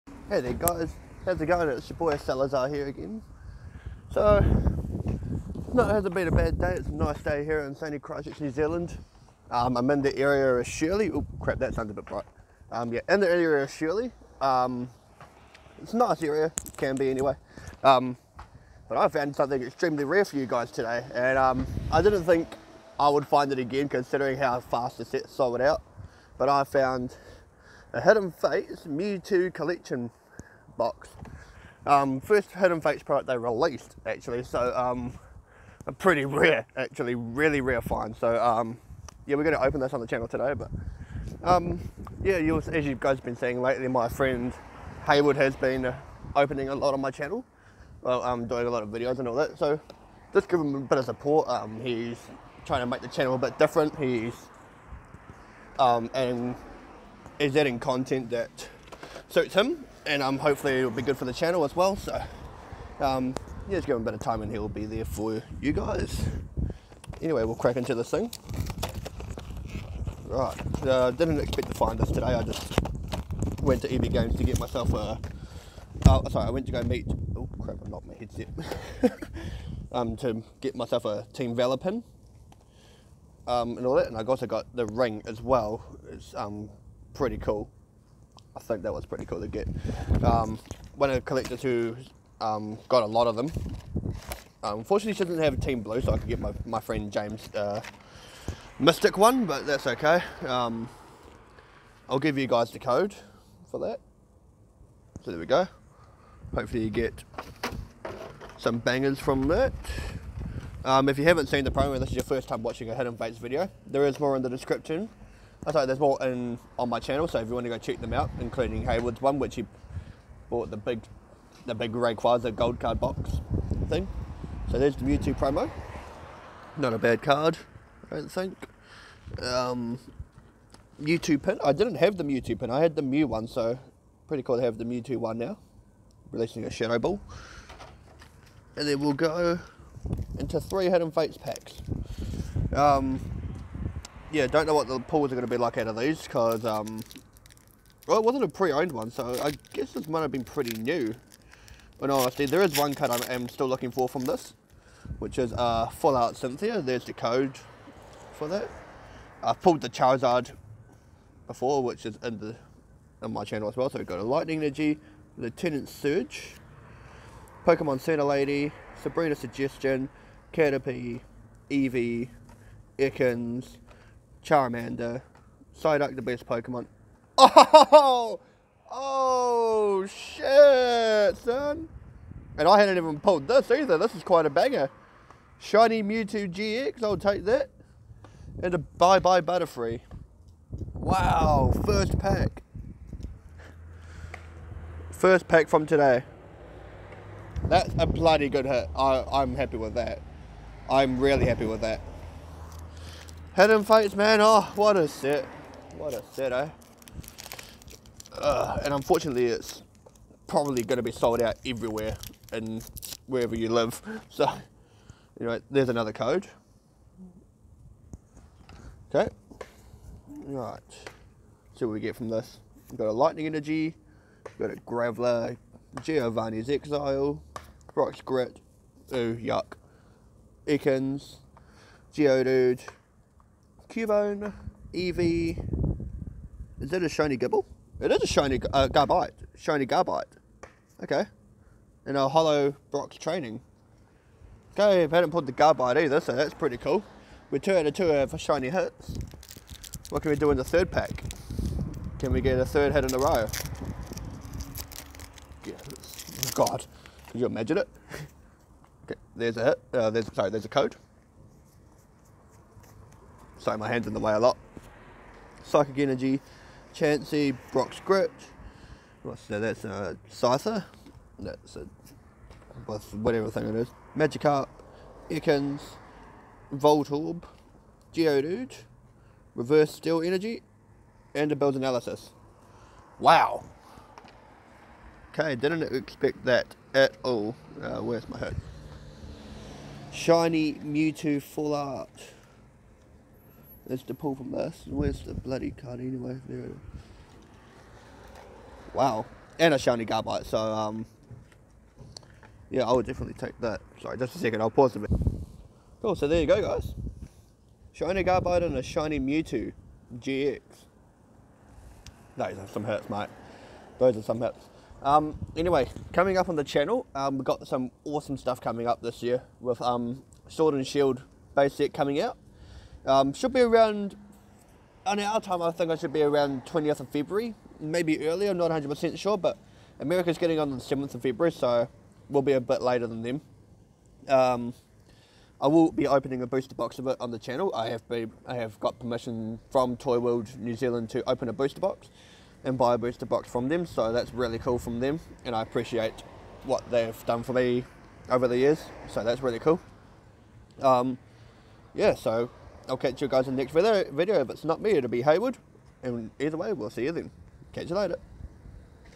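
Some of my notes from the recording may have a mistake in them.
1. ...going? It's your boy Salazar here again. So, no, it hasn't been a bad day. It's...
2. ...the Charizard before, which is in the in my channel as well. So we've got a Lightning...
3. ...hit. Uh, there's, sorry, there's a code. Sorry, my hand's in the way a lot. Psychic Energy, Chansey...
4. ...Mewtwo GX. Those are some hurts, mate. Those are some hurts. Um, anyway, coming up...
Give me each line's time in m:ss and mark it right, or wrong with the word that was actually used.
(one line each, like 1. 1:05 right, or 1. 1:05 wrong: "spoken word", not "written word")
1. 0:01 right
2. 2:39 right
3. 4:19 right
4. 5:09 right.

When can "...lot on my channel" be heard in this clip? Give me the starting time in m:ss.
0:46.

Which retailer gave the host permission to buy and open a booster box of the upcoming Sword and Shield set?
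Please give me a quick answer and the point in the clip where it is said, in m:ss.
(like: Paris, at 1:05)
Toy World New Zealand, at 5:39.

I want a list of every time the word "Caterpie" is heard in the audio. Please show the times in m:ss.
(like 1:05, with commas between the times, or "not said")
2:50.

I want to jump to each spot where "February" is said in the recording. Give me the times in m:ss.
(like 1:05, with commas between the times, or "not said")
5:27, 5:31.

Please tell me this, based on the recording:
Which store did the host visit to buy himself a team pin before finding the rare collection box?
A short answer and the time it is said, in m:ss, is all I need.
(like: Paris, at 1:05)
EB Games, at 1:13.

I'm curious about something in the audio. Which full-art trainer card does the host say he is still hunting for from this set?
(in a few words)
Full Art Cynthia.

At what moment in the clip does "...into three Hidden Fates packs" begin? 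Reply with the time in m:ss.
2:20.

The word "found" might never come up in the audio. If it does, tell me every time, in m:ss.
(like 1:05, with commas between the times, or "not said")
0:19, 0:26.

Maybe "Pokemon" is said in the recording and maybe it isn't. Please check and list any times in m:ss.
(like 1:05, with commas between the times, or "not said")
2:47, 2:56.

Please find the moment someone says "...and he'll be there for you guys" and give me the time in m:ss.
1:04.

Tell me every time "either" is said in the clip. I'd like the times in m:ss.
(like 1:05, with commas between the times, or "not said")
3:03, 4:06, 5:56.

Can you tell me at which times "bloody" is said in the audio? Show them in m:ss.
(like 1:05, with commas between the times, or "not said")
3:18, 4:55.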